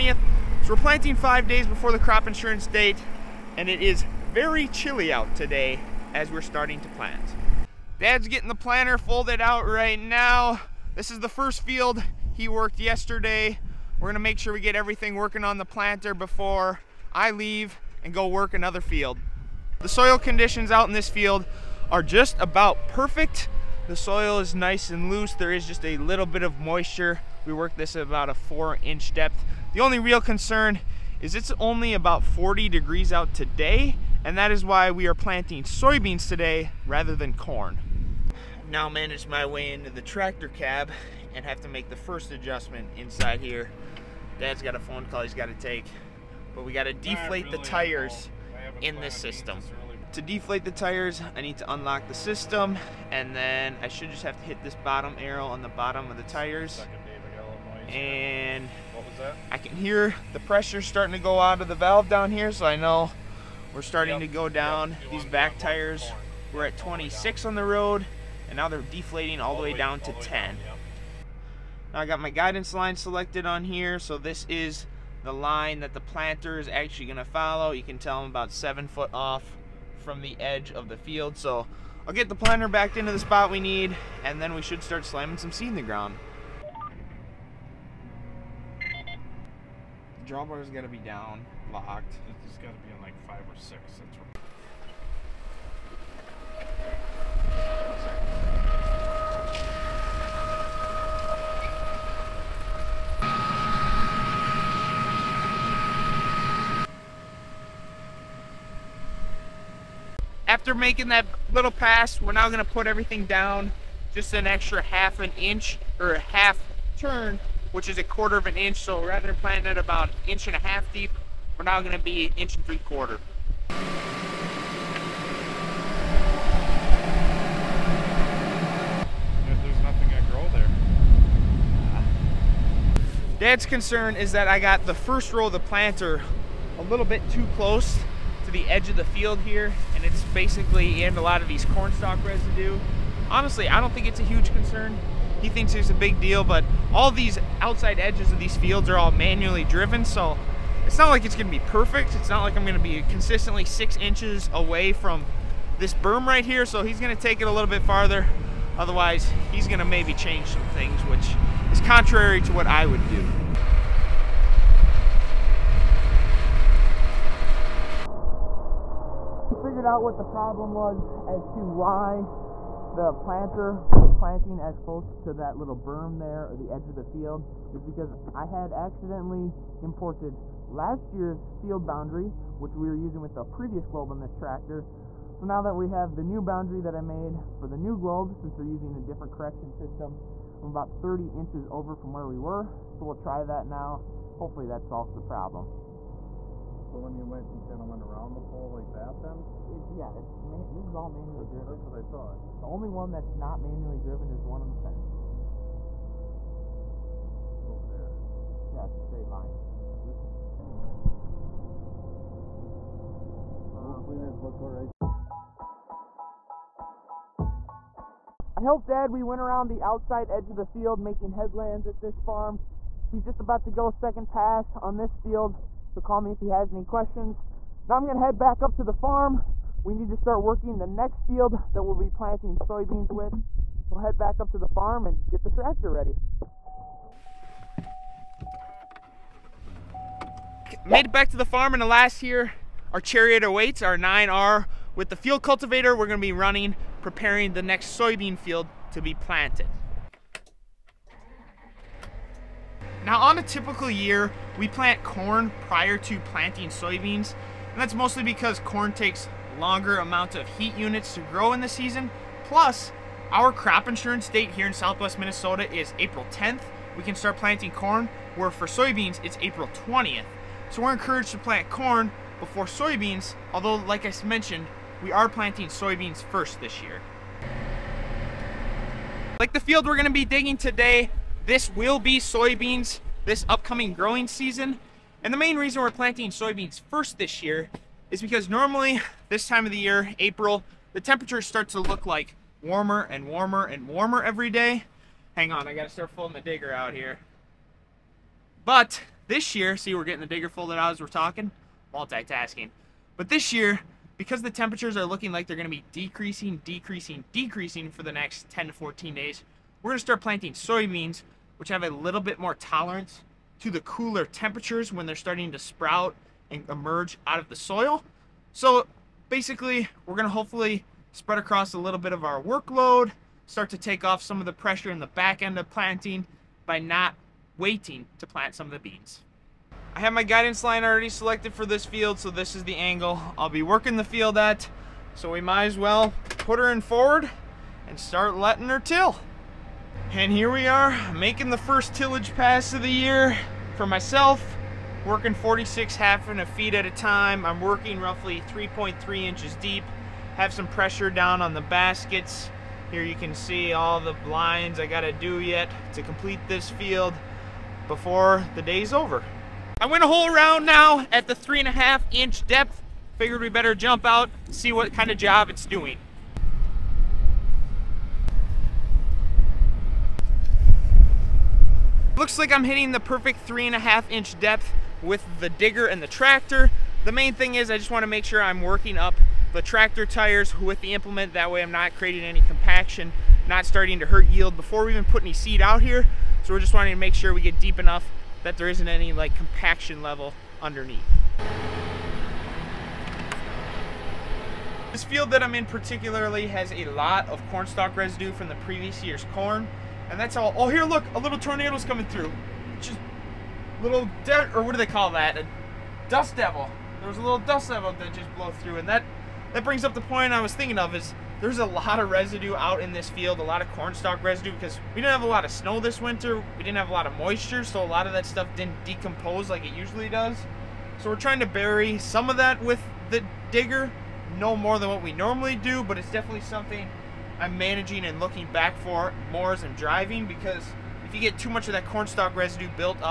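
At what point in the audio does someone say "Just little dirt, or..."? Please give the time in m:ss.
6:42.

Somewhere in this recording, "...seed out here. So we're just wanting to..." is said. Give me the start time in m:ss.
6:25.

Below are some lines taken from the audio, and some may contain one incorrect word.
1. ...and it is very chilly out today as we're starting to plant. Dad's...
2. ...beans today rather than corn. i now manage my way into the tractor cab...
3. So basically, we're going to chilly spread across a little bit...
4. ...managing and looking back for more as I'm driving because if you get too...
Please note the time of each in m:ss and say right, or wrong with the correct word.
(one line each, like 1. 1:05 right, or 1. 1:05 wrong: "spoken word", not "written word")
1. 0:03 right
2. 0:35 wrong: "soybeans", not "beans"
3. 5:18 wrong: "hopefully", not "chilly"
4. 7:07 right.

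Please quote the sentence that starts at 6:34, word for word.
This field that I'm in particularly has a lot of cornstalk residue from the previous year's corn.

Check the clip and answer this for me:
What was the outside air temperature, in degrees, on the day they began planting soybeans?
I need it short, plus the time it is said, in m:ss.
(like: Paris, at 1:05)
40, at 0:32.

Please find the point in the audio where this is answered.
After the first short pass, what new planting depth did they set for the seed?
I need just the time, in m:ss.
2:02.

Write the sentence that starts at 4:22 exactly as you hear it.
Plus, our crop insurance date here in southwest Minnesota is April 10th.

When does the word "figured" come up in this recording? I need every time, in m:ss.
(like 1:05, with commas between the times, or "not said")
2:49, 6:03.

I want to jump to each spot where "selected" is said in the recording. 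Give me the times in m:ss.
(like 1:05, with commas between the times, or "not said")
1:12, 5:31.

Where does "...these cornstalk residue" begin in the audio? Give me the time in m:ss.
2:21.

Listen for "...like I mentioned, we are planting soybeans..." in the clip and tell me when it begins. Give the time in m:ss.
4:33.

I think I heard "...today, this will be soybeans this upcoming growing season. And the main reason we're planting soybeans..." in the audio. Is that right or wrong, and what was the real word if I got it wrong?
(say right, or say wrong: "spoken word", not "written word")
right.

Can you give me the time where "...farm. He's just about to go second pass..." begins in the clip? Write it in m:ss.
3:42.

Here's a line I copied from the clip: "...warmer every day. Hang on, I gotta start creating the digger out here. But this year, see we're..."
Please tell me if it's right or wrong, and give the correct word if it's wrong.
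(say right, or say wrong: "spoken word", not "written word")
wrong: "folding", not "creating".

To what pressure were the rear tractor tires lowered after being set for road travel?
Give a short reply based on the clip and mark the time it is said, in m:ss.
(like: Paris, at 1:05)
10, at 1:09.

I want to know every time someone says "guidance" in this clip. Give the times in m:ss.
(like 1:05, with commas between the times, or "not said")
1:12, 5:30.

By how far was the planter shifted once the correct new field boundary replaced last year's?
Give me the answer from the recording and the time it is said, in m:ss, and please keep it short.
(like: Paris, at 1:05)
30 inches, at 3:10.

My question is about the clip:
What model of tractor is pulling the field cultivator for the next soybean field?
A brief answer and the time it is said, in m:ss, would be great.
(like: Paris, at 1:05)
9R, at 4:03.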